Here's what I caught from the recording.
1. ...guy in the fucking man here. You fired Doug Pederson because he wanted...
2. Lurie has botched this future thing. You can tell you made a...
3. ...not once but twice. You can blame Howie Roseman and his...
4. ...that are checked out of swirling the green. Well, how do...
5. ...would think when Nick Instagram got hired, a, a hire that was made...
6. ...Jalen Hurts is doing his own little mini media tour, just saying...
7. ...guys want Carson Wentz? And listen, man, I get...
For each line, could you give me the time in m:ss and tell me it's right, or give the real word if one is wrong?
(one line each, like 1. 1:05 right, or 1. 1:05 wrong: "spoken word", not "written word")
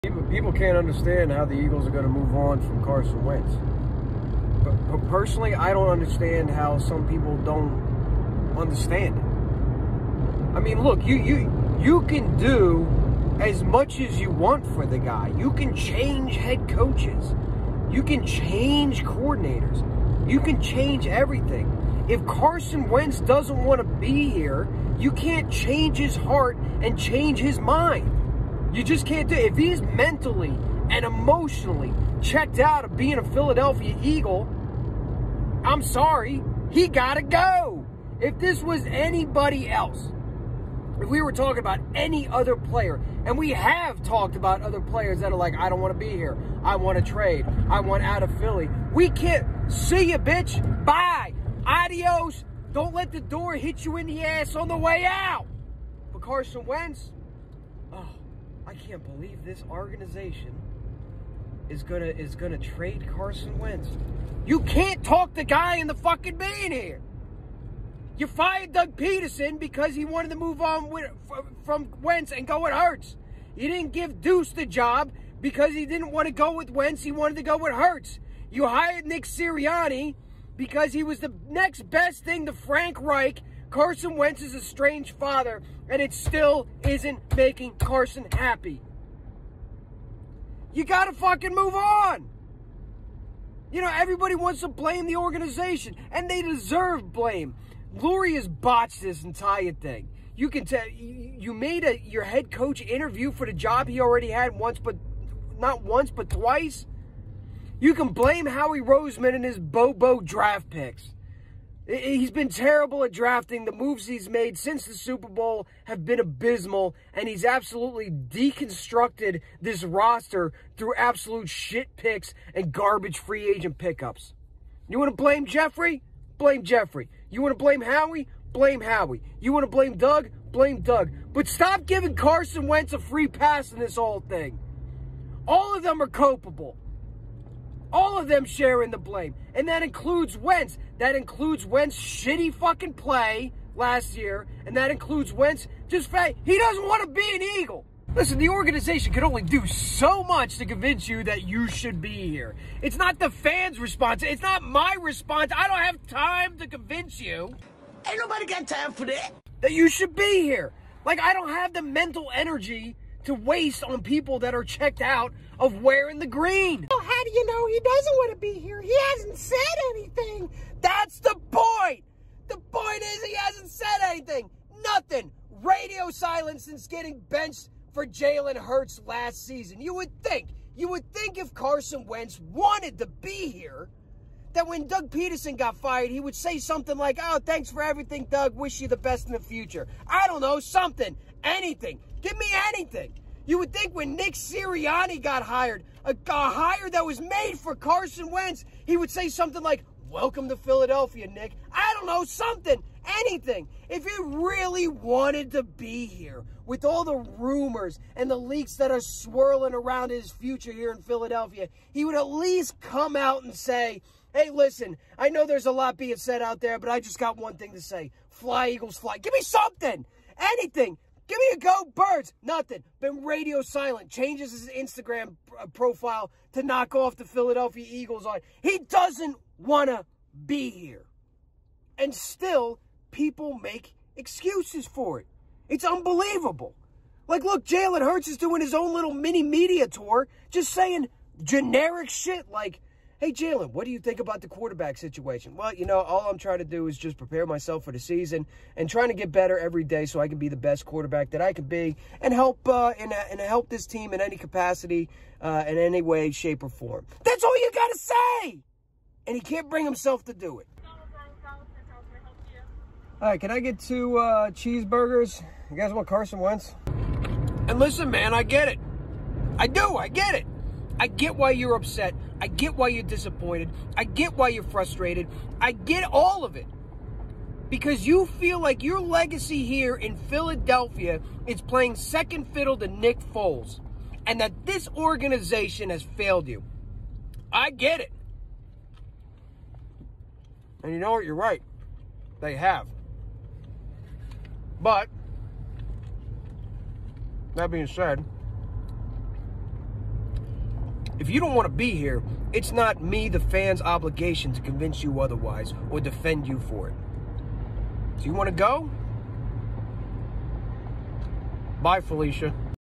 1. 1:05 right
2. 1:37 wrong: "entire", not "future"
3. 1:45 right
4. 2:44 wrong: "wearing", not "swirling"
5. 3:13 wrong: "Sirianni", not "Instagram"
6. 3:57 right
7. 4:25 right.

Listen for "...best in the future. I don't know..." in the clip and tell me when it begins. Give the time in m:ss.
3:08.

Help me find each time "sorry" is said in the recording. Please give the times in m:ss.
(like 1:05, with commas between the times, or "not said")
0:35.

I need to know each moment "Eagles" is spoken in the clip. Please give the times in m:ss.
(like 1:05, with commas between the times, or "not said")
0:01, 0:34, 2:27, 3:38, 3:47.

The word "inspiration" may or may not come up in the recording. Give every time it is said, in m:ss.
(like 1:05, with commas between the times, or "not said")
not said.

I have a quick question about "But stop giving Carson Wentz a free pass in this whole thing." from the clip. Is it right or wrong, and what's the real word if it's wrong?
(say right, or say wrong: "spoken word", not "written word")
right.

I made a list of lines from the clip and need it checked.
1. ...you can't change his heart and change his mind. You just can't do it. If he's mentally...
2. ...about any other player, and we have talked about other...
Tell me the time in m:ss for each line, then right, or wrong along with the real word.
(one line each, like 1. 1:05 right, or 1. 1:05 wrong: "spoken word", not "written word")
1. 0:24 right
2. 0:41 right.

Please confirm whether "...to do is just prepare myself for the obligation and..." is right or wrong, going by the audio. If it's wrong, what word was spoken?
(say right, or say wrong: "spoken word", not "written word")
wrong: "season", not "obligation".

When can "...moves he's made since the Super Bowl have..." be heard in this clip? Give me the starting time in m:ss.
1:53.